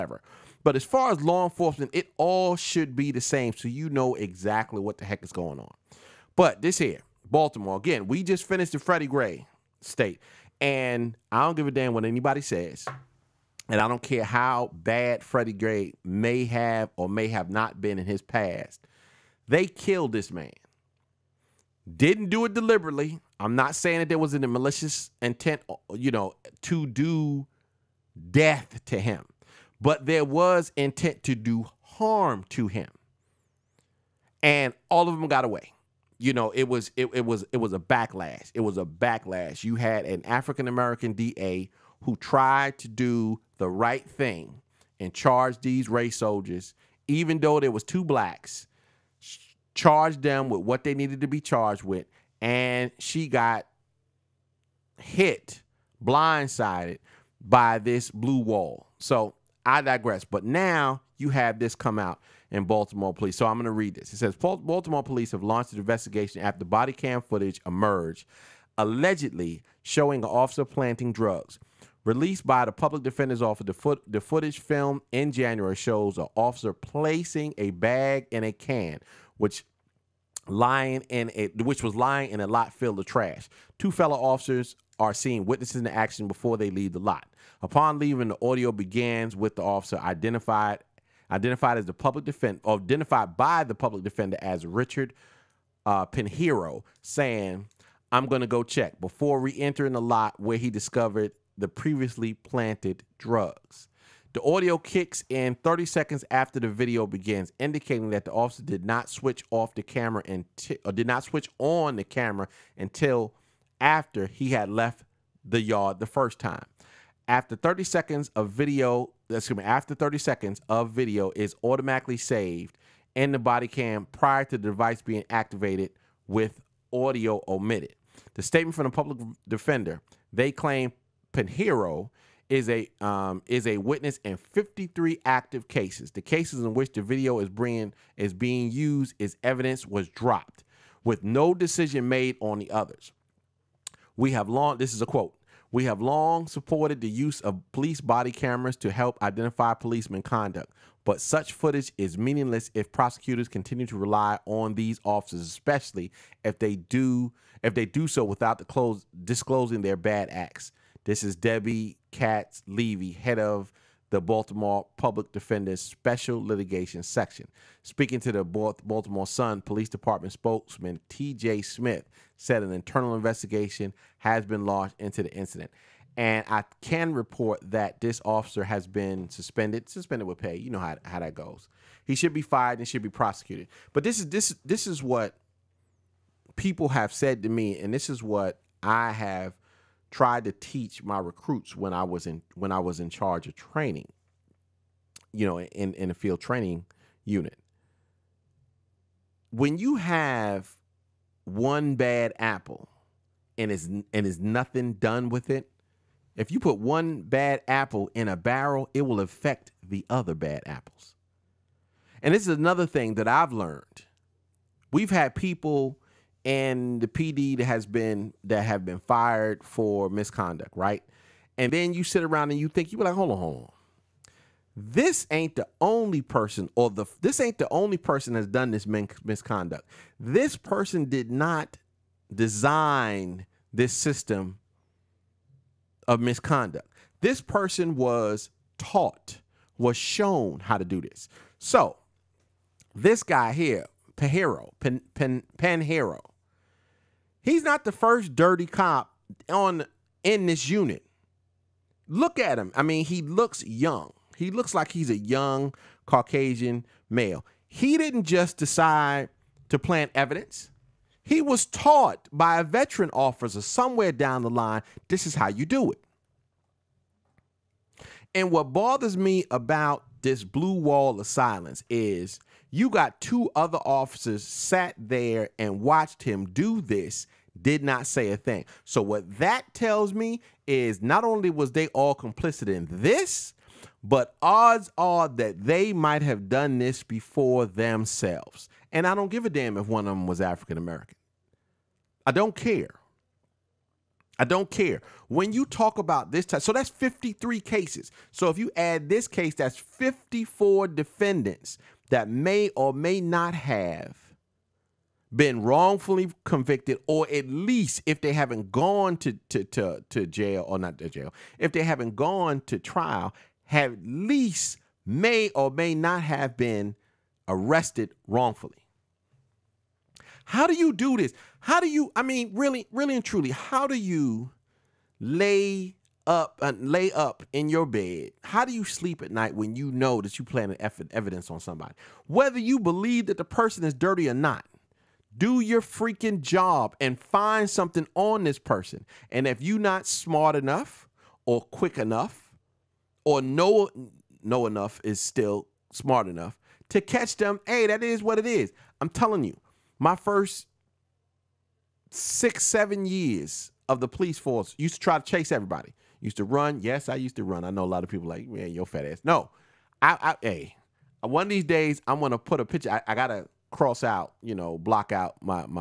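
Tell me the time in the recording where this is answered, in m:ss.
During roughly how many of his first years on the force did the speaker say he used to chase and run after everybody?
5:52.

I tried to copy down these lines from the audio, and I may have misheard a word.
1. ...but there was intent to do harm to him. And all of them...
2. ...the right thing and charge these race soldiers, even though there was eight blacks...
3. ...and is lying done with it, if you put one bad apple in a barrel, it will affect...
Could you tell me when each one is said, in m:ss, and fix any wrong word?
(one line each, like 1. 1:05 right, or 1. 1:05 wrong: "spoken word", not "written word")
1. 0:29 right
2. 0:43 wrong: "two", not "eight"
3. 3:23 wrong: "nothing", not "lying".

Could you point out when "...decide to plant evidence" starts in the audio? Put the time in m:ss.
4:18.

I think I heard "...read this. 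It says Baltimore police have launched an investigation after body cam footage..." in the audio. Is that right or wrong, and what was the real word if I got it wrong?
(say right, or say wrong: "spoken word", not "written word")
right.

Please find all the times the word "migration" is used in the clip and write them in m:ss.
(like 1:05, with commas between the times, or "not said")
not said.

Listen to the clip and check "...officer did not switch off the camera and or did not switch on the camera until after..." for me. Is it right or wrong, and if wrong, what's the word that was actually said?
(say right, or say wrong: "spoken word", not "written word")
right.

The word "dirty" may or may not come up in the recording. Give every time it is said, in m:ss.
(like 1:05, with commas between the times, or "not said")
4:08, 5:33.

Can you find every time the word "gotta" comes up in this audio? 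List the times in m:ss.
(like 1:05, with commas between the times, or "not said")
6:03.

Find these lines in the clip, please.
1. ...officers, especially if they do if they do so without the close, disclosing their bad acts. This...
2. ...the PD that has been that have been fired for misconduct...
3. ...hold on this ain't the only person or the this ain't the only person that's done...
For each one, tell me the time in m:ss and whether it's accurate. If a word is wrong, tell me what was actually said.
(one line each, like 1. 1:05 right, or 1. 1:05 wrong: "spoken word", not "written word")
1. 2:35 right
2. 3:37 right
3. 3:43 right.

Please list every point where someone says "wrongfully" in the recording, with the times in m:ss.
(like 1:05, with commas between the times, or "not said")
5:05, 5:18.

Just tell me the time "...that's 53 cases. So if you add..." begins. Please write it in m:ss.
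4:56.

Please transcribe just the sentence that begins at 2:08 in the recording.
The statement from the public defender, they claim Pinheiro is a um, is a witness in 53 active cases.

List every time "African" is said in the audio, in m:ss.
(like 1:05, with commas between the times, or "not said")
0:40, 4:50.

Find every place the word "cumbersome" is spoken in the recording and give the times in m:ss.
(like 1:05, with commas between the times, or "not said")
not said.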